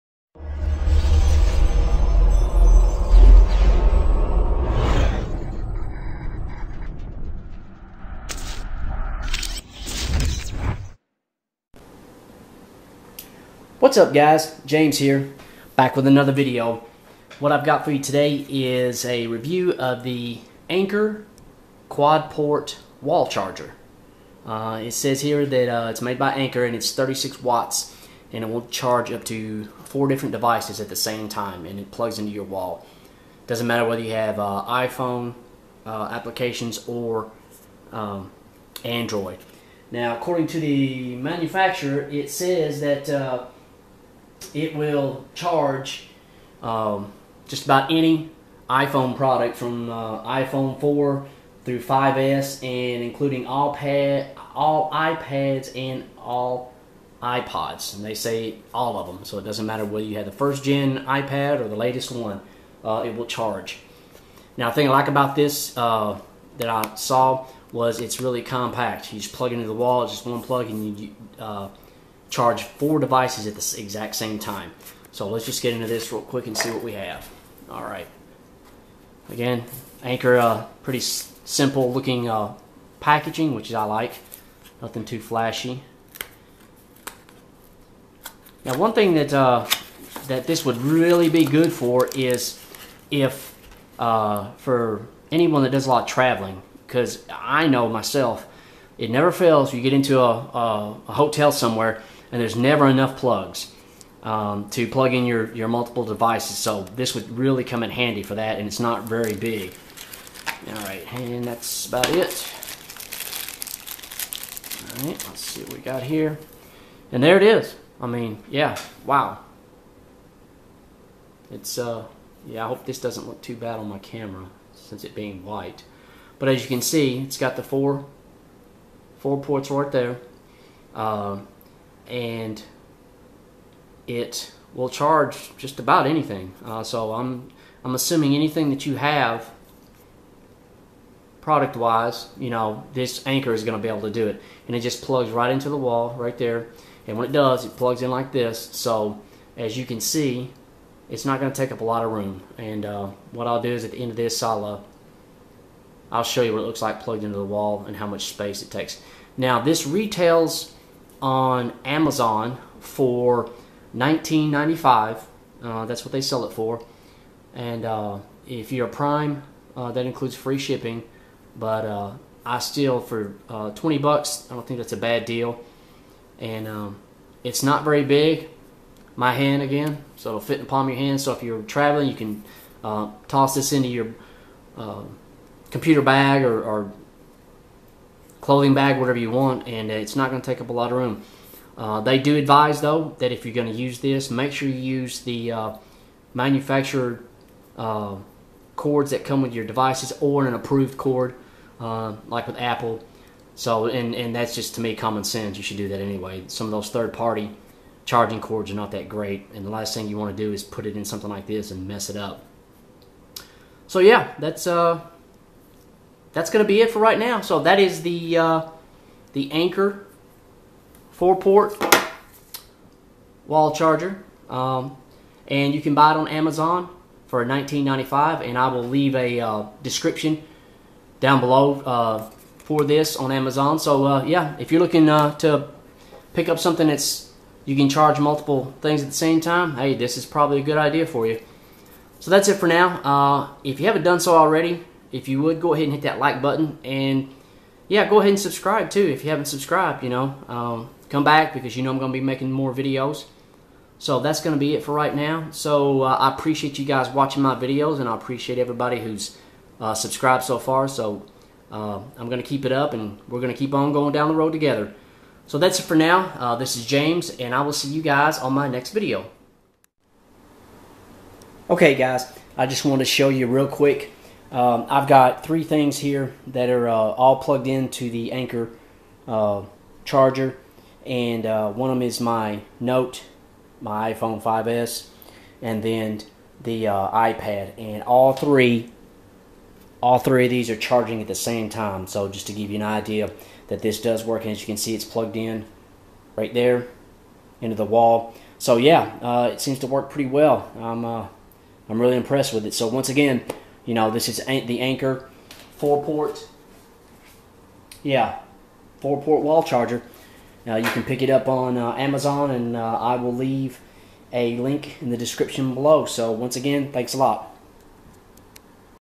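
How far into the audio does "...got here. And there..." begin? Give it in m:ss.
1:55.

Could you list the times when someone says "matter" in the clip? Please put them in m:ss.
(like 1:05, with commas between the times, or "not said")
0:33, 0:59.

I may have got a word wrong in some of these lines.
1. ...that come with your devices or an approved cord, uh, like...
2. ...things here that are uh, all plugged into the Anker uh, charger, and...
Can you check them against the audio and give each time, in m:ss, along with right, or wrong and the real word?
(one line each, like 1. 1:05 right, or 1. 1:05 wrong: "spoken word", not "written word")
1. 3:19 right
2. 4:35 right.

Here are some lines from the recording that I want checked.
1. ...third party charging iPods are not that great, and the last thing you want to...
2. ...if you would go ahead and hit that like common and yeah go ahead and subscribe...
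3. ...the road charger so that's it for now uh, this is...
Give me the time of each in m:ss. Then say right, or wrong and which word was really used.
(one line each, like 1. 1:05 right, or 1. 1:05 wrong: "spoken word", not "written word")
1. 3:26 wrong: "cords", not "iPods"
2. 4:05 wrong: "button", not "common"
3. 4:24 wrong: "together", not "charger".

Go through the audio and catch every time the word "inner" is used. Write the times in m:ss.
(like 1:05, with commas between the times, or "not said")
not said.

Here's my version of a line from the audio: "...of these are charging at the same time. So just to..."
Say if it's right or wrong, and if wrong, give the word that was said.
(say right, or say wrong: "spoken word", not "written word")
right.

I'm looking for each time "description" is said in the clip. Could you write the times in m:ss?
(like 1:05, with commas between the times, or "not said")
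3:49, 5:15.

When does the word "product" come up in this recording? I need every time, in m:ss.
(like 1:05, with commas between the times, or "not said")
0:49, 2:21.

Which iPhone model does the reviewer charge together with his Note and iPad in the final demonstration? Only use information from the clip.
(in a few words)
iPhone 5s.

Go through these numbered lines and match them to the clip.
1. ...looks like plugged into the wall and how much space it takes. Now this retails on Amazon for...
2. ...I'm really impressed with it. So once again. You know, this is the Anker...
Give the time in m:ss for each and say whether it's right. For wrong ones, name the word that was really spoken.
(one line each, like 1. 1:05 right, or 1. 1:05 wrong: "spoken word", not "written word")
1. 2:36 right
2. 5:01 right.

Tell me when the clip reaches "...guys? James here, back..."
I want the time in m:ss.
0:14.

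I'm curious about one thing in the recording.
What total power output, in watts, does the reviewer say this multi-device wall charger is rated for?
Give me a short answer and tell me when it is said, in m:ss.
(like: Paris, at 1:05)
36 watts, at 0:26.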